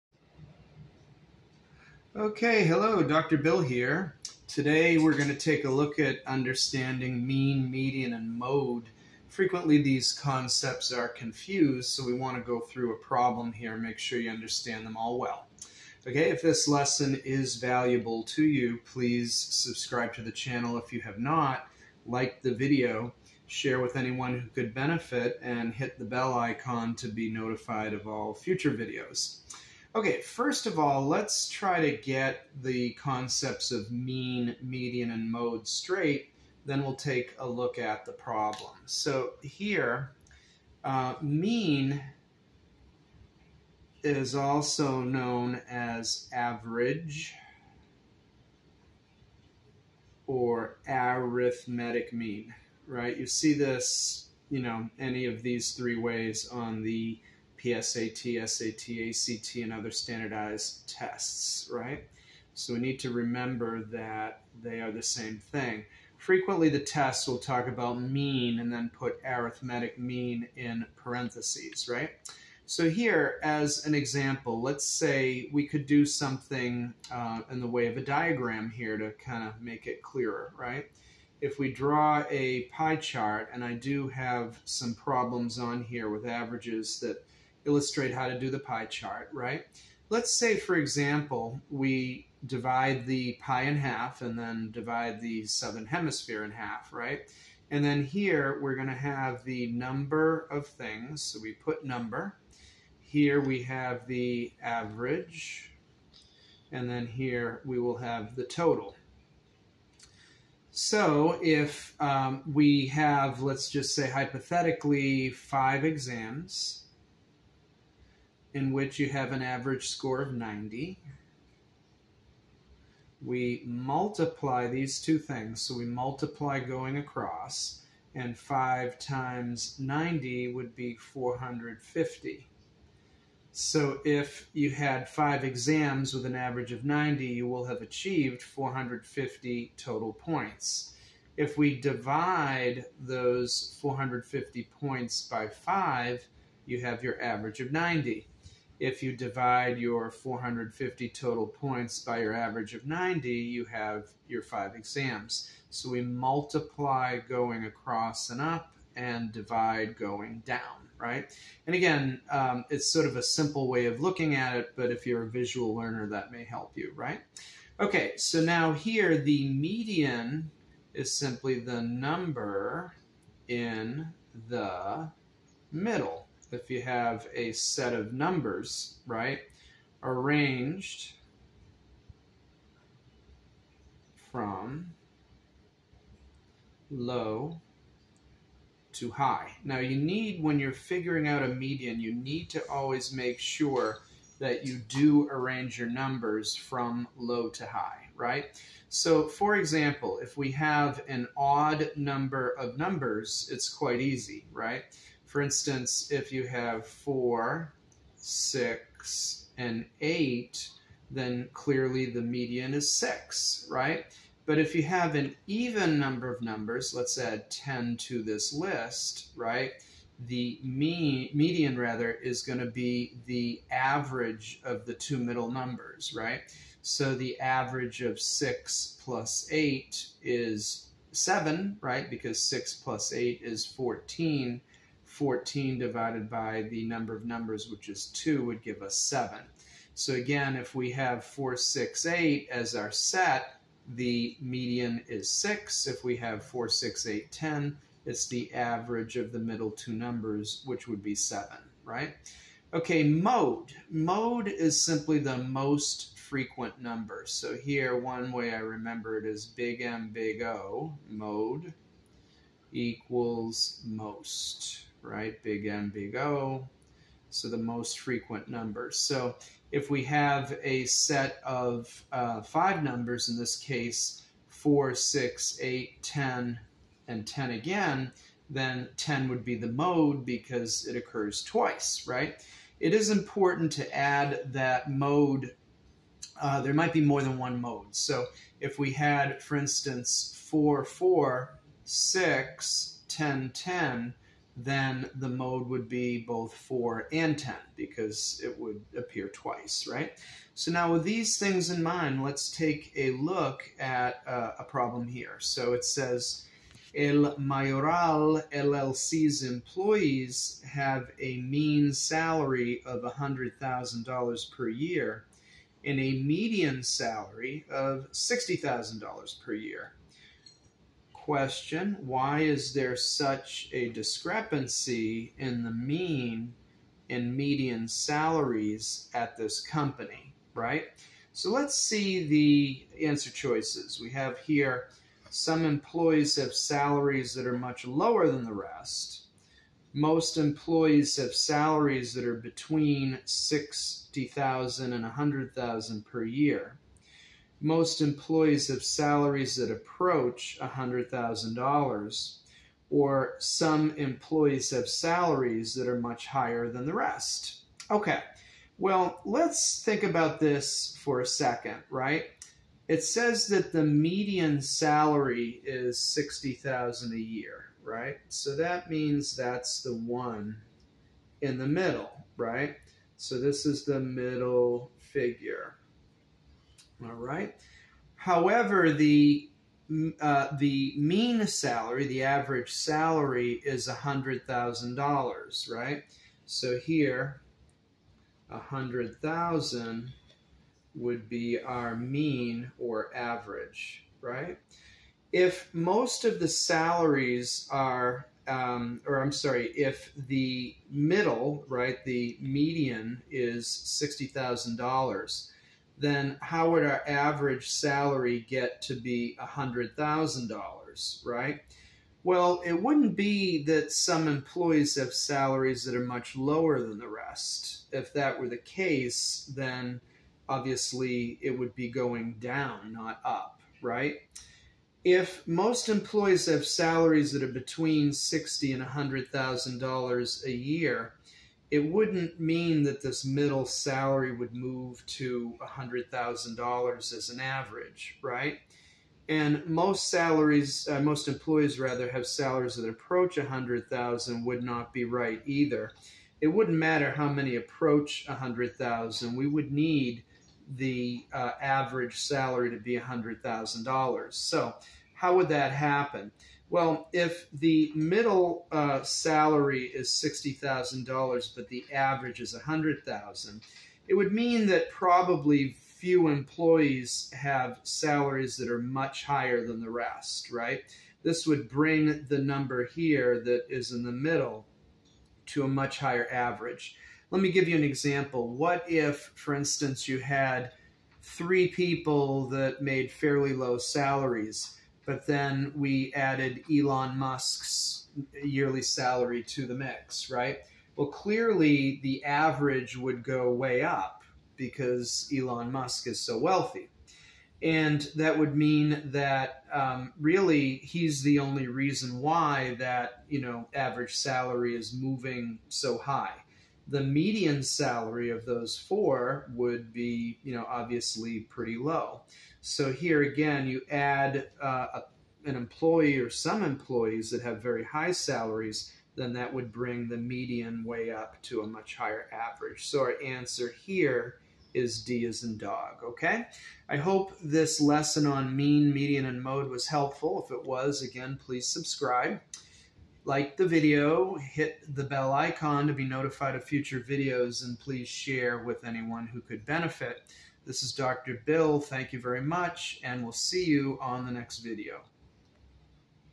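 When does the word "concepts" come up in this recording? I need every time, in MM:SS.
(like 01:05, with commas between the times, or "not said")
00:10, 00:32.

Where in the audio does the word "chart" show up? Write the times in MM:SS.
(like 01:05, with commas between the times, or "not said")
01:22, 01:28.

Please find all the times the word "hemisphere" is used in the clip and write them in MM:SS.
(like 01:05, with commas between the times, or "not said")
01:35.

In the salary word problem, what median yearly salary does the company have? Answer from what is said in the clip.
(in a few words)
$60,000.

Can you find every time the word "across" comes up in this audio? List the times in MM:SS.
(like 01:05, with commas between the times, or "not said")
02:06, 02:37.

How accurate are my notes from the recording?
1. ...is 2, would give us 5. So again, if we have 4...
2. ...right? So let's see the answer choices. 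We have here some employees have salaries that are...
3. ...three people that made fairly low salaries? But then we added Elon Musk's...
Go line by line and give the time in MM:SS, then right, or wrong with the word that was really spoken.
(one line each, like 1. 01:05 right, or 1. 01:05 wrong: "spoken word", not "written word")
1. 03:57 wrong: "7", not "5"
2. 05:30 right
3. 08:01 right.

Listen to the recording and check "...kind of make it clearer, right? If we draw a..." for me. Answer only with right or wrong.
right.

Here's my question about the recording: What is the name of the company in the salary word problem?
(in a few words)
El Mayoral LLC.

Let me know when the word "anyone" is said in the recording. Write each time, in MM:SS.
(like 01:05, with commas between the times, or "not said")
00:23, 08:58.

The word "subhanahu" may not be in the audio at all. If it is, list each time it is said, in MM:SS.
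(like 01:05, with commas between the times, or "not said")
not said.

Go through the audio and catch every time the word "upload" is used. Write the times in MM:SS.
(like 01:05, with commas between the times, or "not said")
not said.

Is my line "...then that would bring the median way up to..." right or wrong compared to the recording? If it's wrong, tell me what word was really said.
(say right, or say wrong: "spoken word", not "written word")
right.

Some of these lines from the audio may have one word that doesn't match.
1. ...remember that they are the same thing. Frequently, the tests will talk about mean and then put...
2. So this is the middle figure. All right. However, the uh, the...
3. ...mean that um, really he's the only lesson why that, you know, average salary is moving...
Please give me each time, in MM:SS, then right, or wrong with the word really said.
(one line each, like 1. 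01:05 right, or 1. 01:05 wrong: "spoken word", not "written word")
1. 01:03 right
2. 06:13 right
3. 08:18 wrong: "reason", not "lesson".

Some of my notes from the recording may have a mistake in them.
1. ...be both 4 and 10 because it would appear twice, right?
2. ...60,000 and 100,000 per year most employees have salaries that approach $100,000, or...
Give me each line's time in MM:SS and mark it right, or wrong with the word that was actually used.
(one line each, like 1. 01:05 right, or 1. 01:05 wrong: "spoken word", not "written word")
1. 04:55 right
2. 05:43 right.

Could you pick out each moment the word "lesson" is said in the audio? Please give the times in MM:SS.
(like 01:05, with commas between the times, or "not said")
00:16, 08:47.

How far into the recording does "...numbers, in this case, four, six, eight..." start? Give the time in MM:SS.
04:32.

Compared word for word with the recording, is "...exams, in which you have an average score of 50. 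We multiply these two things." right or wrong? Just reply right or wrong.
wrong.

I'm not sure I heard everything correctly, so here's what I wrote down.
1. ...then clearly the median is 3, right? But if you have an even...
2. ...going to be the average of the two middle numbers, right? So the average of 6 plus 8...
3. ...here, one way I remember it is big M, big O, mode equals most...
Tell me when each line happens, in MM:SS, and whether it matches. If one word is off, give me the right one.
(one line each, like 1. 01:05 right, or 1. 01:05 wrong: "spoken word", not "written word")
1. 03:31 wrong: "6", not "3"
2. 03:42 right
3. 04:17 right.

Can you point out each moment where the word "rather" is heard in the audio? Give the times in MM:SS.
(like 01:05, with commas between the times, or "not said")
03:41, 07:21.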